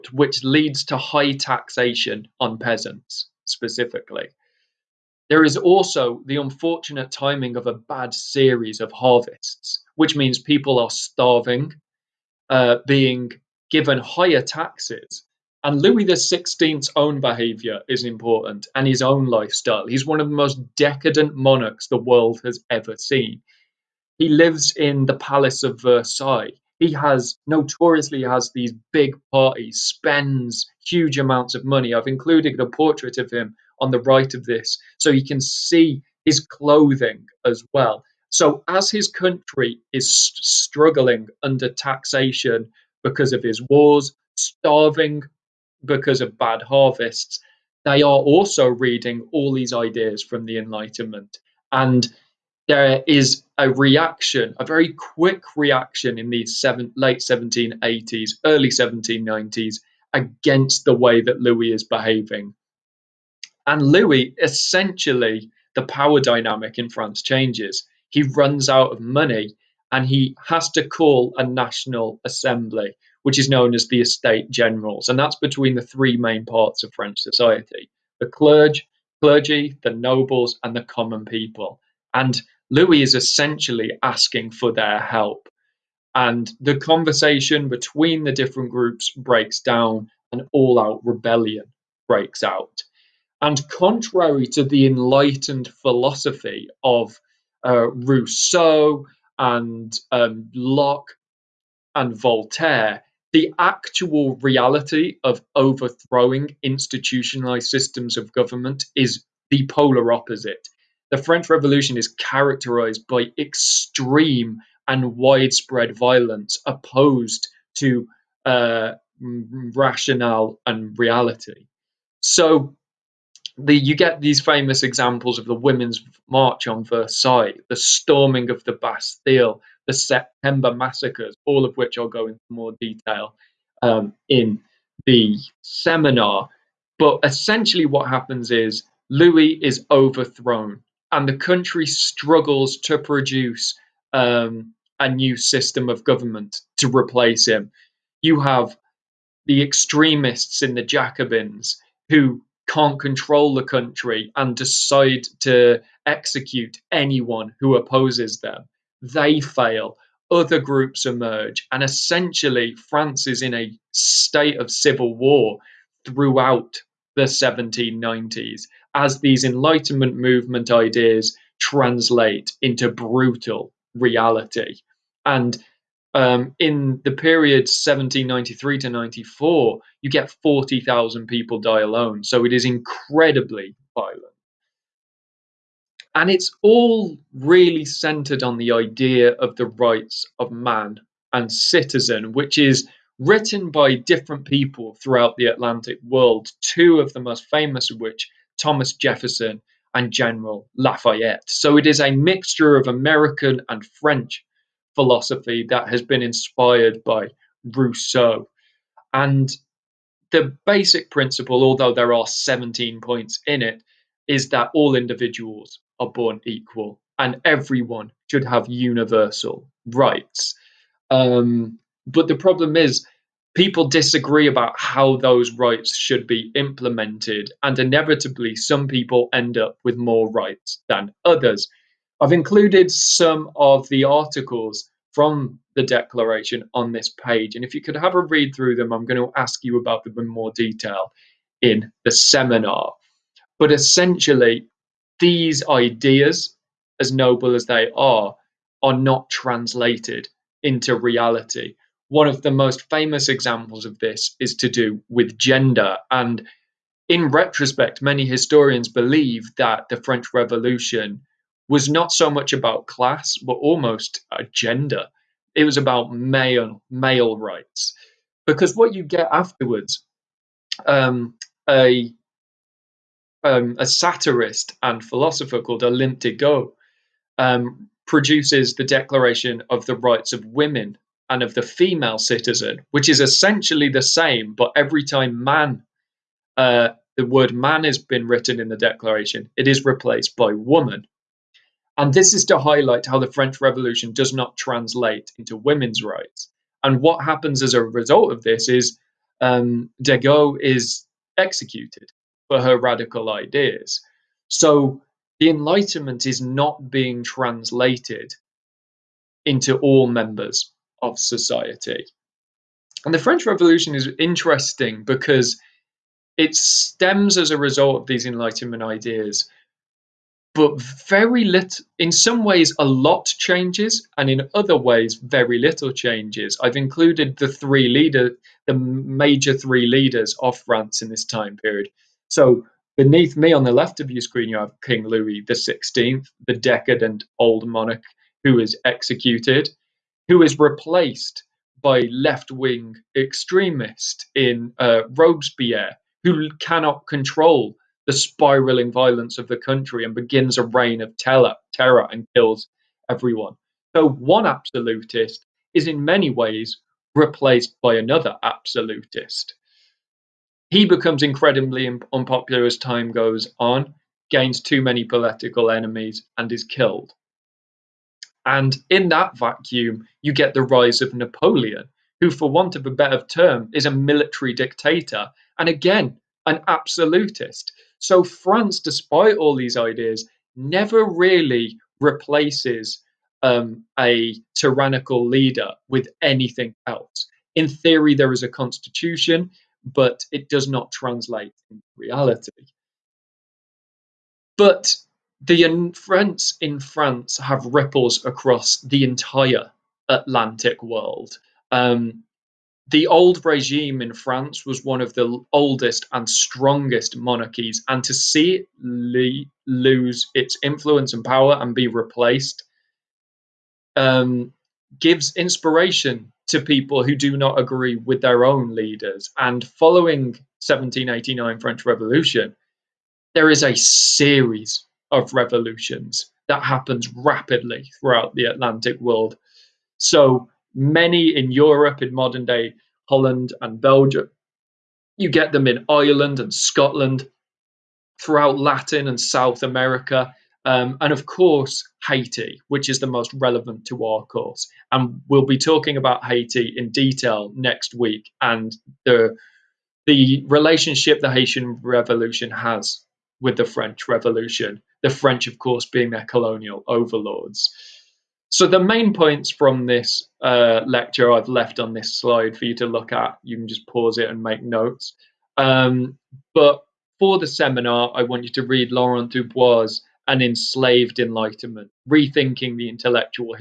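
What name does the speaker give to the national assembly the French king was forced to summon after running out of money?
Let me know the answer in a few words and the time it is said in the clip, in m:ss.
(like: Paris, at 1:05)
Estate Generals, at 1:14.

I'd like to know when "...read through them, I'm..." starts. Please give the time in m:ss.
3:58.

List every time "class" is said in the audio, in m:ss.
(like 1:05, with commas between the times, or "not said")
4:22.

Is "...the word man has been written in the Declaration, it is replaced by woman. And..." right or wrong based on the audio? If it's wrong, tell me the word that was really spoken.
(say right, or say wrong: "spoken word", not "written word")
right.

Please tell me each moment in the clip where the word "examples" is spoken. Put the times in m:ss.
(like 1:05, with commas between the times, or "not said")
2:04, 4:13.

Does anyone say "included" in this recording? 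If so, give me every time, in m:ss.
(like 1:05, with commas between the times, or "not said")
0:32, 3:52, 5:26.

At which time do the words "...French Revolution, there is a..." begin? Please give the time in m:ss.
7:01.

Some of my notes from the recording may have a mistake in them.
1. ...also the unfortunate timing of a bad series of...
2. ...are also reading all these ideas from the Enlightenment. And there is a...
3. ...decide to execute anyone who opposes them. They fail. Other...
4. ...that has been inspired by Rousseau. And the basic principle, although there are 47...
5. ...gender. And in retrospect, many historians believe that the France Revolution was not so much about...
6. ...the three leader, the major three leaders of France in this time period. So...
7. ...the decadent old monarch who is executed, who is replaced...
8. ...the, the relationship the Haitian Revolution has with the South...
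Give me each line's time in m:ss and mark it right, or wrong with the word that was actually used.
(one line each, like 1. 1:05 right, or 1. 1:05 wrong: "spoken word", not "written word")
1. 0:05 right
2. 0:48 right
3. 2:34 right
4. 3:25 wrong: "17", not "47"
5. 4:15 wrong: "French", not "France"
6. 5:27 right
7. 5:36 right
8. 7:29 wrong: "French", not "South".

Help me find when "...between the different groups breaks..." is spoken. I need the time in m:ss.
1:27.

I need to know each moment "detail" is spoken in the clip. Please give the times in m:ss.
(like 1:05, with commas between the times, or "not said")
2:12, 4:00, 7:26.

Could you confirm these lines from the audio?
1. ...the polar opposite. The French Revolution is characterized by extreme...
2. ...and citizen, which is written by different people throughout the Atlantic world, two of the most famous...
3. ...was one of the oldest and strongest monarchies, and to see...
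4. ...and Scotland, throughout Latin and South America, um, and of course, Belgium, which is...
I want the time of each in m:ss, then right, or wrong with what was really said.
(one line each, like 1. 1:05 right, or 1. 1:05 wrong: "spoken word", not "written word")
1. 1:49 right
2. 3:11 right
3. 6:44 right
4. 7:16 wrong: "Haiti", not "Belgium".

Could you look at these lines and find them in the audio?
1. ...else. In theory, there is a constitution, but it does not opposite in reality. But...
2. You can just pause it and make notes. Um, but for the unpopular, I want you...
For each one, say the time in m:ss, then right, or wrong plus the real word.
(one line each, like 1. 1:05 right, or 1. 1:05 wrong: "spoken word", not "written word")
1. 6:26 wrong: "translate", not "opposite"
2. 7:43 wrong: "seminar", not "unpopular".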